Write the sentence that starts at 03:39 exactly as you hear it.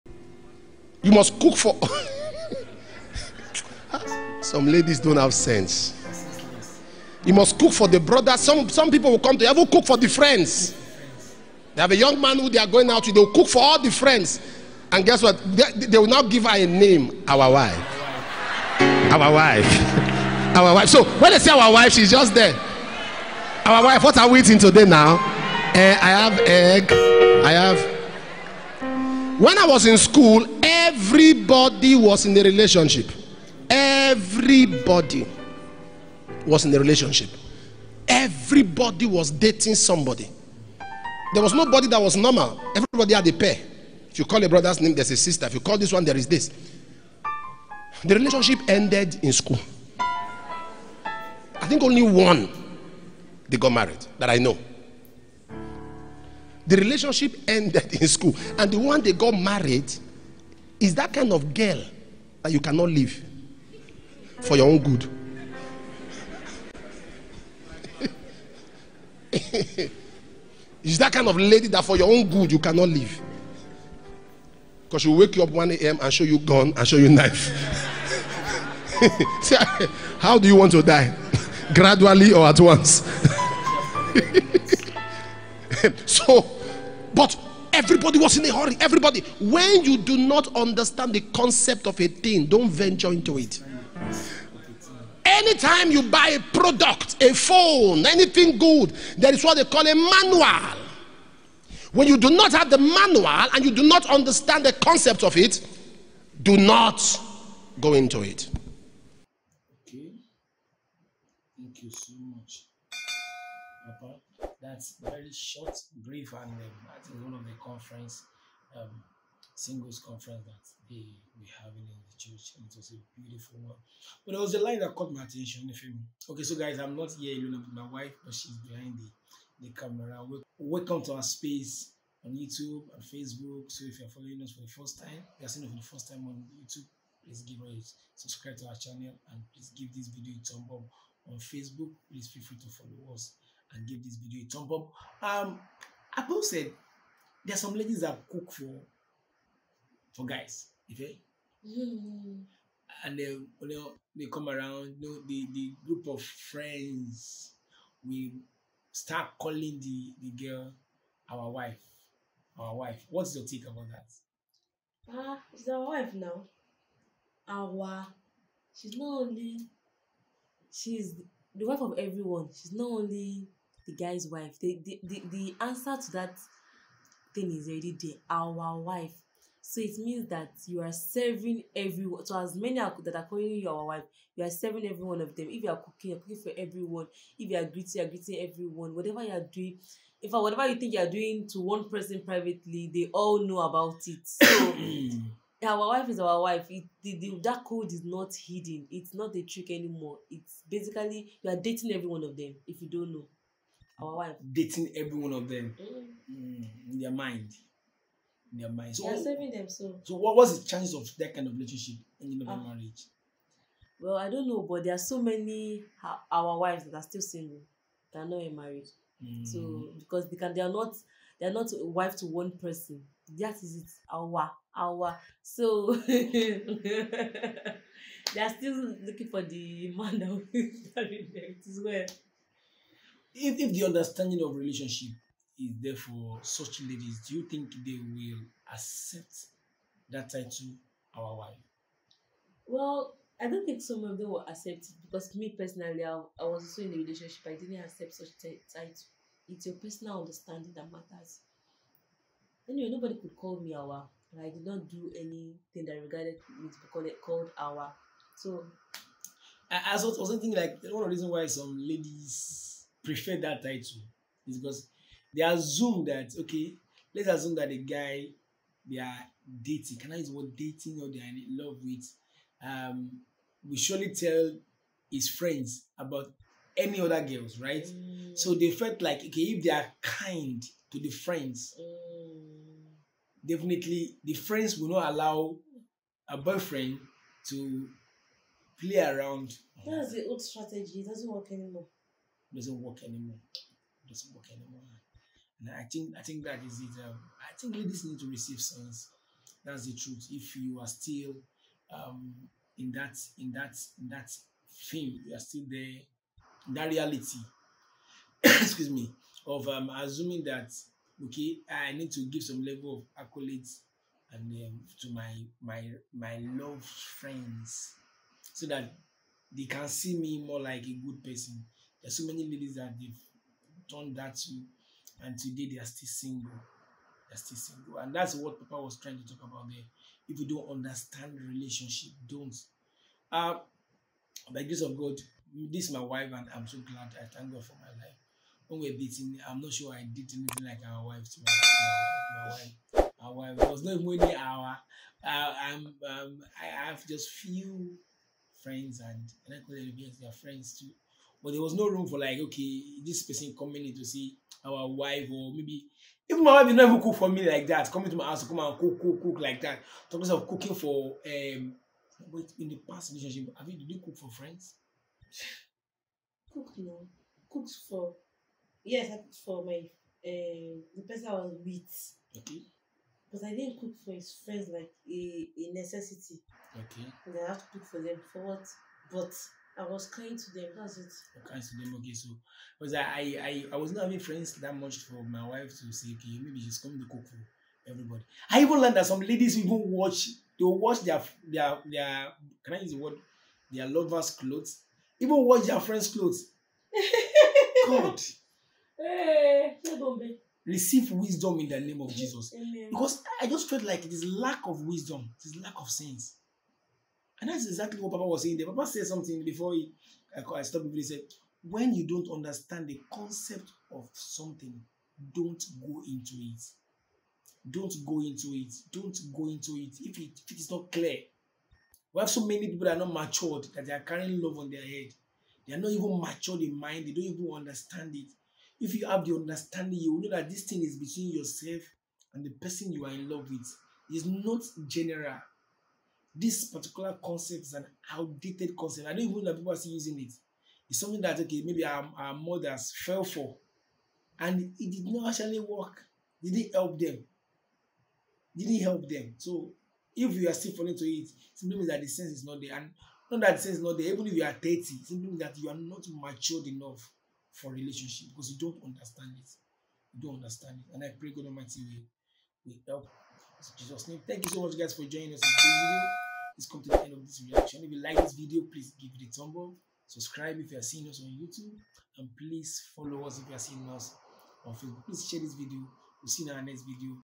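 So because they can, they are not, they are not a wife to one person.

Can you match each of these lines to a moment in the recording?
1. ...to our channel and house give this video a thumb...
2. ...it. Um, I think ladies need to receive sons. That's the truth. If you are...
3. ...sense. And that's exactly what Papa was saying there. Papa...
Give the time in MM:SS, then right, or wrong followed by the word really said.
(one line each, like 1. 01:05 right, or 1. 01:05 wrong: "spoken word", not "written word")
1. 02:18 wrong: "please", not "house"
2. 04:56 right
3. 06:45 right.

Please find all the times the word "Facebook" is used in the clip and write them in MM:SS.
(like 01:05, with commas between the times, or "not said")
02:13, 02:21, 07:54.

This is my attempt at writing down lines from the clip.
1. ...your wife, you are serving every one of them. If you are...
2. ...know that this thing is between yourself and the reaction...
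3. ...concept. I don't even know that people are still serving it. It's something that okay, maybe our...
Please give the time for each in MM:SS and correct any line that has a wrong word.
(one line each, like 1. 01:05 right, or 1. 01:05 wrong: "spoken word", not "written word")
1. 03:03 right
2. 07:10 wrong: "person", not "reaction"
3. 07:18 wrong: "using", not "serving".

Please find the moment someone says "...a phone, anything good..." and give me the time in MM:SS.
01:37.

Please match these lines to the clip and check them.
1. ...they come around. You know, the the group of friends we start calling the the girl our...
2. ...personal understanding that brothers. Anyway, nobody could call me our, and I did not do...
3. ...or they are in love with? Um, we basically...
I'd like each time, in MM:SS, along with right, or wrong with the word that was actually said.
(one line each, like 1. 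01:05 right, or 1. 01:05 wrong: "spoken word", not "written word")
1. 02:34 right
2. 04:09 wrong: "matters", not "brothers"
3. 04:31 wrong: "surely", not "basically".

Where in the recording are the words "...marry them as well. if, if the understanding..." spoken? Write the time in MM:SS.
03:50.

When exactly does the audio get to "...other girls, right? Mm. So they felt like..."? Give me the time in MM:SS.
04:37.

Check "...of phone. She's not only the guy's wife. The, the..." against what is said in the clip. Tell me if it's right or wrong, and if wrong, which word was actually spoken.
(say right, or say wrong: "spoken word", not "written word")
wrong: "everyone", not "phone".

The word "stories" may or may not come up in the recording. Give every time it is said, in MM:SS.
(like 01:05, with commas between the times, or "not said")
not said.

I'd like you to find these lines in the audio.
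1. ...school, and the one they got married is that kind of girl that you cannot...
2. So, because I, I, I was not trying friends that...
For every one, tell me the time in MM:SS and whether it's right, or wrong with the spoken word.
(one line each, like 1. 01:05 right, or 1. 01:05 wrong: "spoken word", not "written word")
1. 00:58 right
2. 06:22 wrong: "having", not "trying".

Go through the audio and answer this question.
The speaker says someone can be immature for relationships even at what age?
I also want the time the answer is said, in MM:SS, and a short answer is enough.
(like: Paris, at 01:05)
30, at 07:34.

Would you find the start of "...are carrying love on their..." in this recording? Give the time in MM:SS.
07:03.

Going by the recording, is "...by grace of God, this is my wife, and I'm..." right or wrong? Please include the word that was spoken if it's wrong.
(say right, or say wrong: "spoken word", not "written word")
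right.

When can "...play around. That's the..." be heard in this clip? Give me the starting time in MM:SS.
04:48.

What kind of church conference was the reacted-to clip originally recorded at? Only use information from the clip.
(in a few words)
Singles conference.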